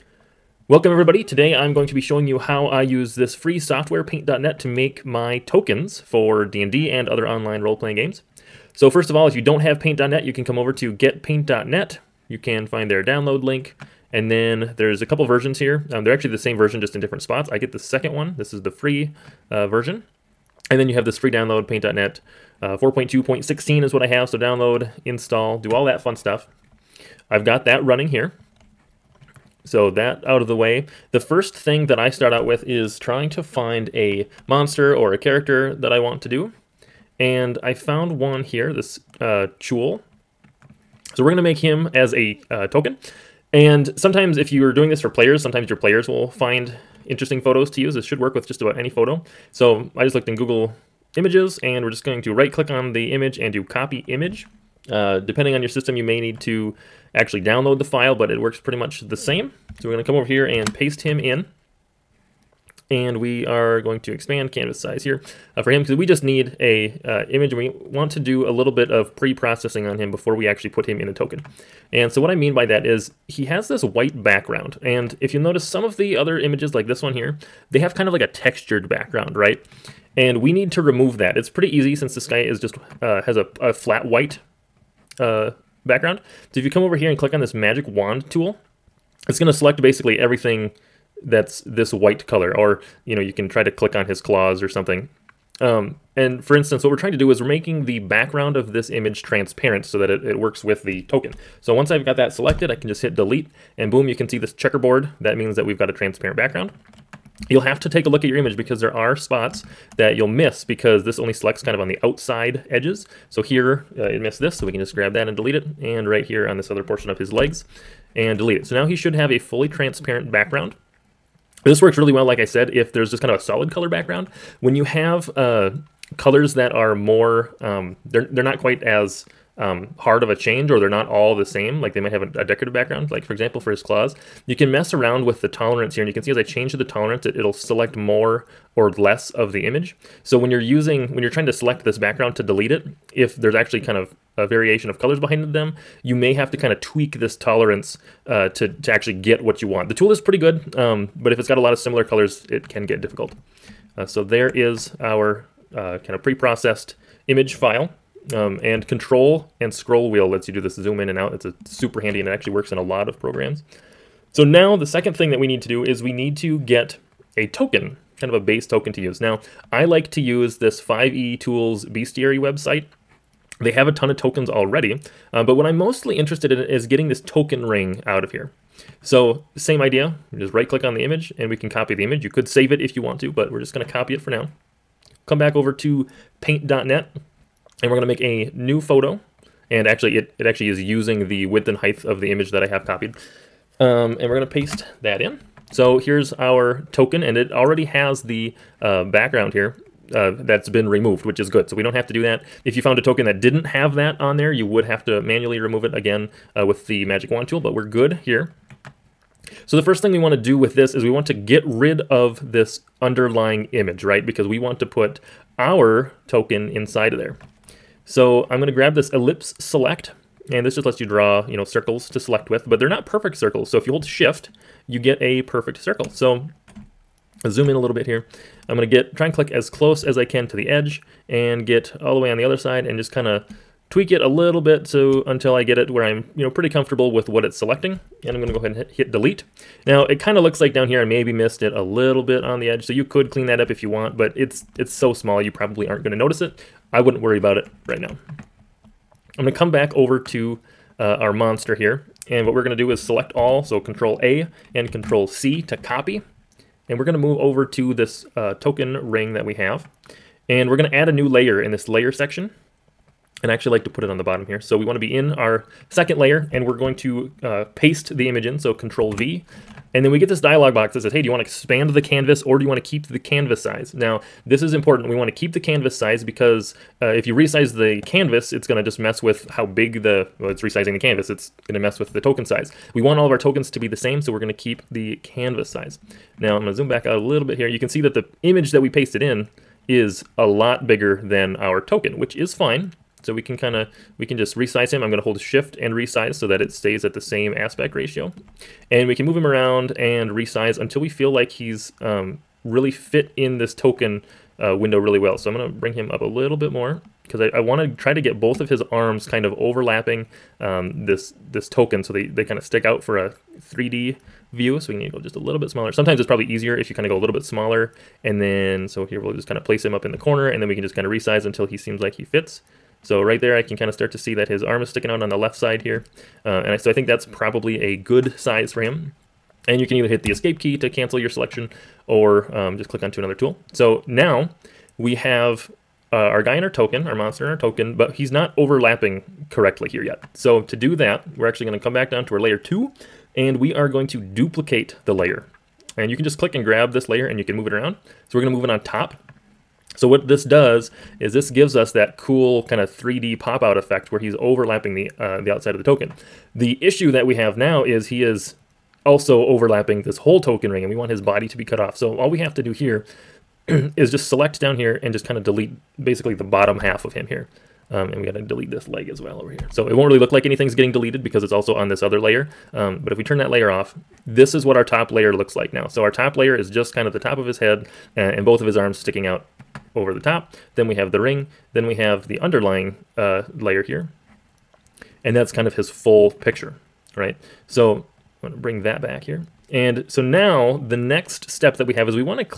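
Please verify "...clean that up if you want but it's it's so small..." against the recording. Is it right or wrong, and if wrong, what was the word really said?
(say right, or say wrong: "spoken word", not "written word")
right.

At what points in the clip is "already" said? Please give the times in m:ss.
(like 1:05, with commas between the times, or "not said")
2:54, 3:17.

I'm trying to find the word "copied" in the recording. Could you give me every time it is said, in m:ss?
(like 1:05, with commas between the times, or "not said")
3:12.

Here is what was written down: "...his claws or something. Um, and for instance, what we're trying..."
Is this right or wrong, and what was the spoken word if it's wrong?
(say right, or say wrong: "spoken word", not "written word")
right.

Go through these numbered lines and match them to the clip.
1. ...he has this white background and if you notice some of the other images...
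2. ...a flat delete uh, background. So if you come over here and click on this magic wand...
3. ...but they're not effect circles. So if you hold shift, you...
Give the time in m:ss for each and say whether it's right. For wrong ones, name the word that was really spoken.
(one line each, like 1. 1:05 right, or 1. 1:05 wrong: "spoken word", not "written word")
1. 1:13 right
2. 1:23 wrong: "white", not "delete"
3. 3:42 wrong: "perfect", not "effect".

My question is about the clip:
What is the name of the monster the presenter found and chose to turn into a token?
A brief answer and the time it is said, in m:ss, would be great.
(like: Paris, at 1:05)
Chuul, at 0:39.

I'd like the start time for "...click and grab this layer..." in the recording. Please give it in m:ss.
5:46.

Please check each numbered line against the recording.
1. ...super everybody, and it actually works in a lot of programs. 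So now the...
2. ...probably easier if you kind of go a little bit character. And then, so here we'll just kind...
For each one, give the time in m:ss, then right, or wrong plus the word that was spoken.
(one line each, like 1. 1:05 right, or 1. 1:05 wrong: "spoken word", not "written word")
1. 2:41 wrong: "handy", not "everybody"
2. 5:16 wrong: "smaller", not "character".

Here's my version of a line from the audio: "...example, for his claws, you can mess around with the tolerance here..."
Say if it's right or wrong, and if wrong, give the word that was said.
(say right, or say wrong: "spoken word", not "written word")
right.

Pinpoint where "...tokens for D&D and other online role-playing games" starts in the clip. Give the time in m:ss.
0:05.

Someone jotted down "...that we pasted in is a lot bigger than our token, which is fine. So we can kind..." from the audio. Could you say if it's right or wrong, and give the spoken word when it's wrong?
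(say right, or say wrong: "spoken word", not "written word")
right.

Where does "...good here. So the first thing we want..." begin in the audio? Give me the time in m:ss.
3:27.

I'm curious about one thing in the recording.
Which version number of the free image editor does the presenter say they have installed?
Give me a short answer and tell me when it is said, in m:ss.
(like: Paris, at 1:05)
4.2.16, at 0:22.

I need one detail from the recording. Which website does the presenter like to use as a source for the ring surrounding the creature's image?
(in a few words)
5e Tools Bestiary.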